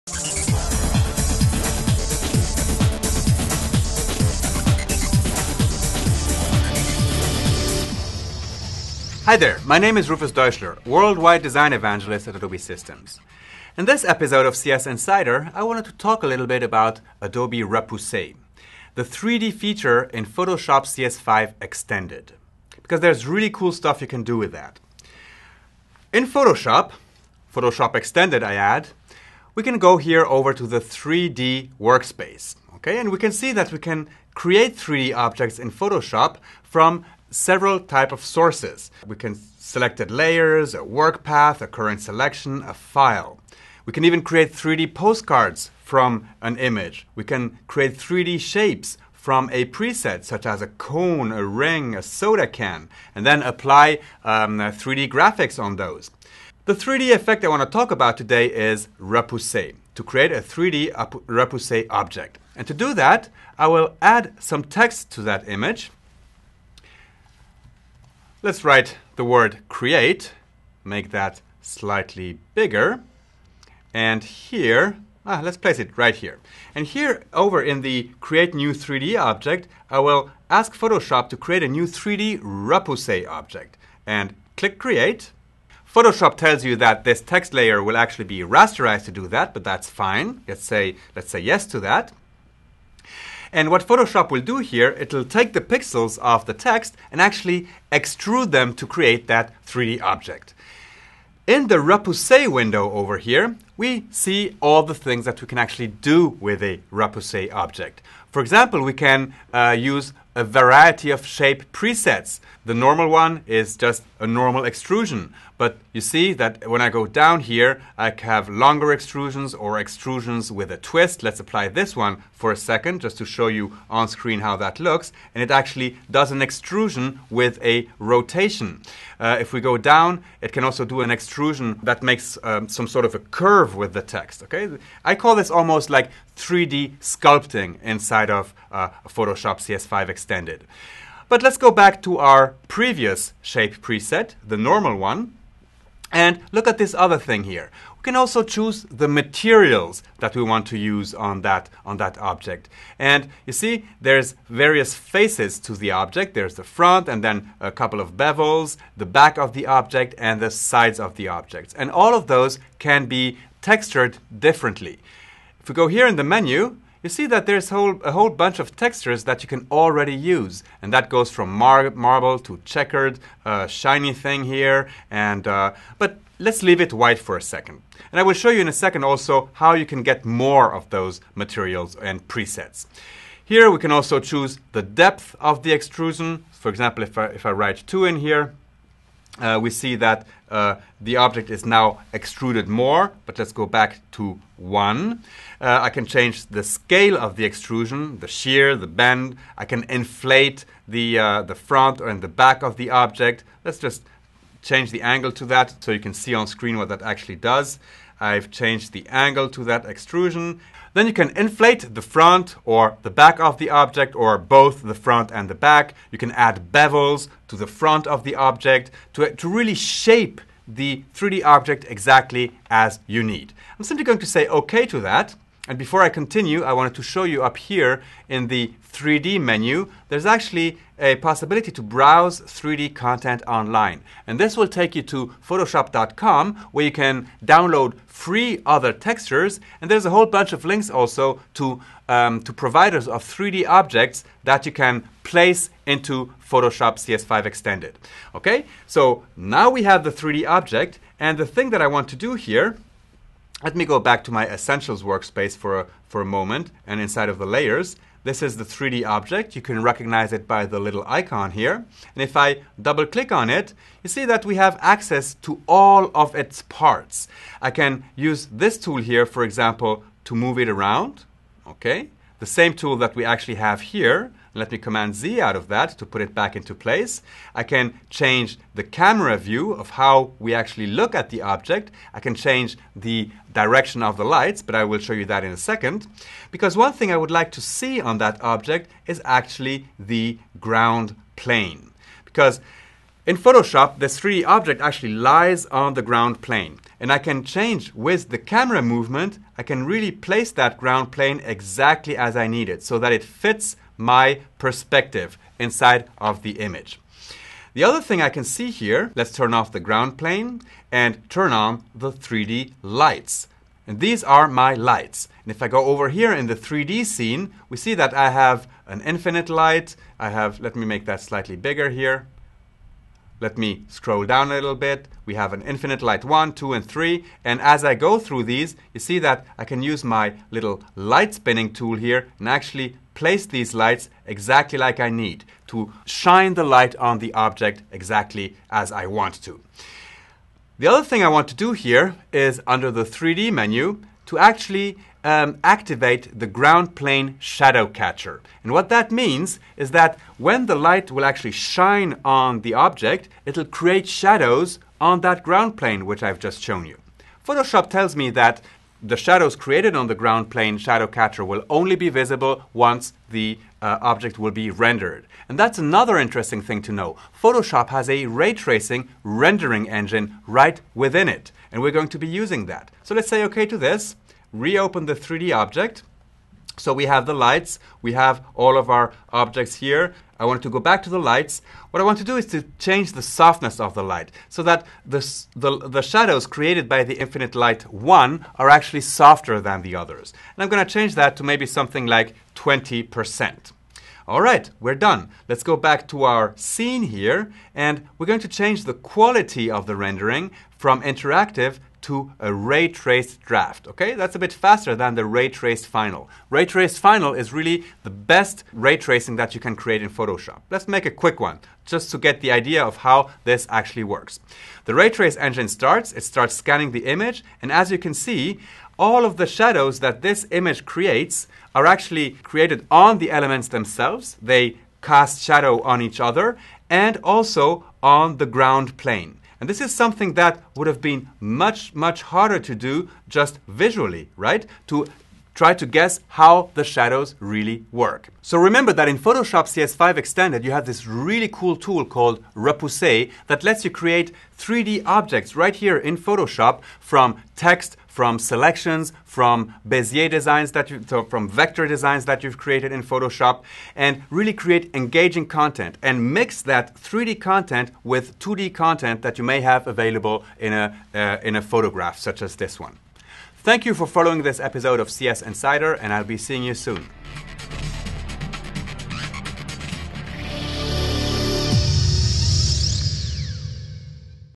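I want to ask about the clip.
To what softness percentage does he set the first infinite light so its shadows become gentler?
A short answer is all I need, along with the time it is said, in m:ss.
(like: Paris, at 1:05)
20%, at 6:32.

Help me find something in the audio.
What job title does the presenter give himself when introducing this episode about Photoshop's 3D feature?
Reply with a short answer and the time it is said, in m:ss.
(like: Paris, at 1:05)
Worldwide Design Evangelist, at 0:10.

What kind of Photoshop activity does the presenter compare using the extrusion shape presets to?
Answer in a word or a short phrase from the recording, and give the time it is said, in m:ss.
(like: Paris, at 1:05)
3D sculpting, at 2:16.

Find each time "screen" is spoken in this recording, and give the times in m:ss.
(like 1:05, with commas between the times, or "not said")
2:04, 3:26.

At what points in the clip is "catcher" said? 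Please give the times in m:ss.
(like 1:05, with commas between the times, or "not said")
5:47, 6:01.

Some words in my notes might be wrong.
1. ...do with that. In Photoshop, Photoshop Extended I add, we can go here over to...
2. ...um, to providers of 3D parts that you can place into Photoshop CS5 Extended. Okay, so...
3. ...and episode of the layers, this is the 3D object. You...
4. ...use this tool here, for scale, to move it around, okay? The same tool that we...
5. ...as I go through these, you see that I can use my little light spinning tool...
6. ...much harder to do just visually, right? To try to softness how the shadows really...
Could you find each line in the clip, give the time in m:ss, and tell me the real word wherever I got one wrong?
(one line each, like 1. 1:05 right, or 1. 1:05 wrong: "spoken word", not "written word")
1. 0:24 right
2. 4:02 wrong: "objects", not "parts"
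3. 4:16 wrong: "inside", not "episode"
4. 4:28 wrong: "example", not "scale"
5. 5:27 right
6. 7:11 wrong: "guess", not "softness".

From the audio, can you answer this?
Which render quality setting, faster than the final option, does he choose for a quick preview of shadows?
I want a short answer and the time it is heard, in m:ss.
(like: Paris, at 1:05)
ray traced draft, at 6:42.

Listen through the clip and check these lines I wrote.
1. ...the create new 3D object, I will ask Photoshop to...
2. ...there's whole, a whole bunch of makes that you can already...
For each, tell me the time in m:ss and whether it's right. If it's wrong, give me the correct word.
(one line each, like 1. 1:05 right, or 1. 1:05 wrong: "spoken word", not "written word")
1. 1:17 right
2. 2:47 wrong: "textures", not "makes".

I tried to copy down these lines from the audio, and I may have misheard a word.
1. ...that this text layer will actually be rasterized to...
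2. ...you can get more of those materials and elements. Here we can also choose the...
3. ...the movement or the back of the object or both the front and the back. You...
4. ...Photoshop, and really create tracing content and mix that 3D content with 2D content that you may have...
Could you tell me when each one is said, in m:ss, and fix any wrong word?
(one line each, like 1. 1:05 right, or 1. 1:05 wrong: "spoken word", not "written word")
1. 1:26 right
2. 2:59 wrong: "presets", not "elements"
3. 3:31 wrong: "front", not "movement"
4. 7:33 wrong: "engaging", not "tracing".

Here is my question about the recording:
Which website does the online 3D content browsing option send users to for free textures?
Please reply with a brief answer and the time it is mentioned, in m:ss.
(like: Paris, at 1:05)
photoshop.com, at 3:55.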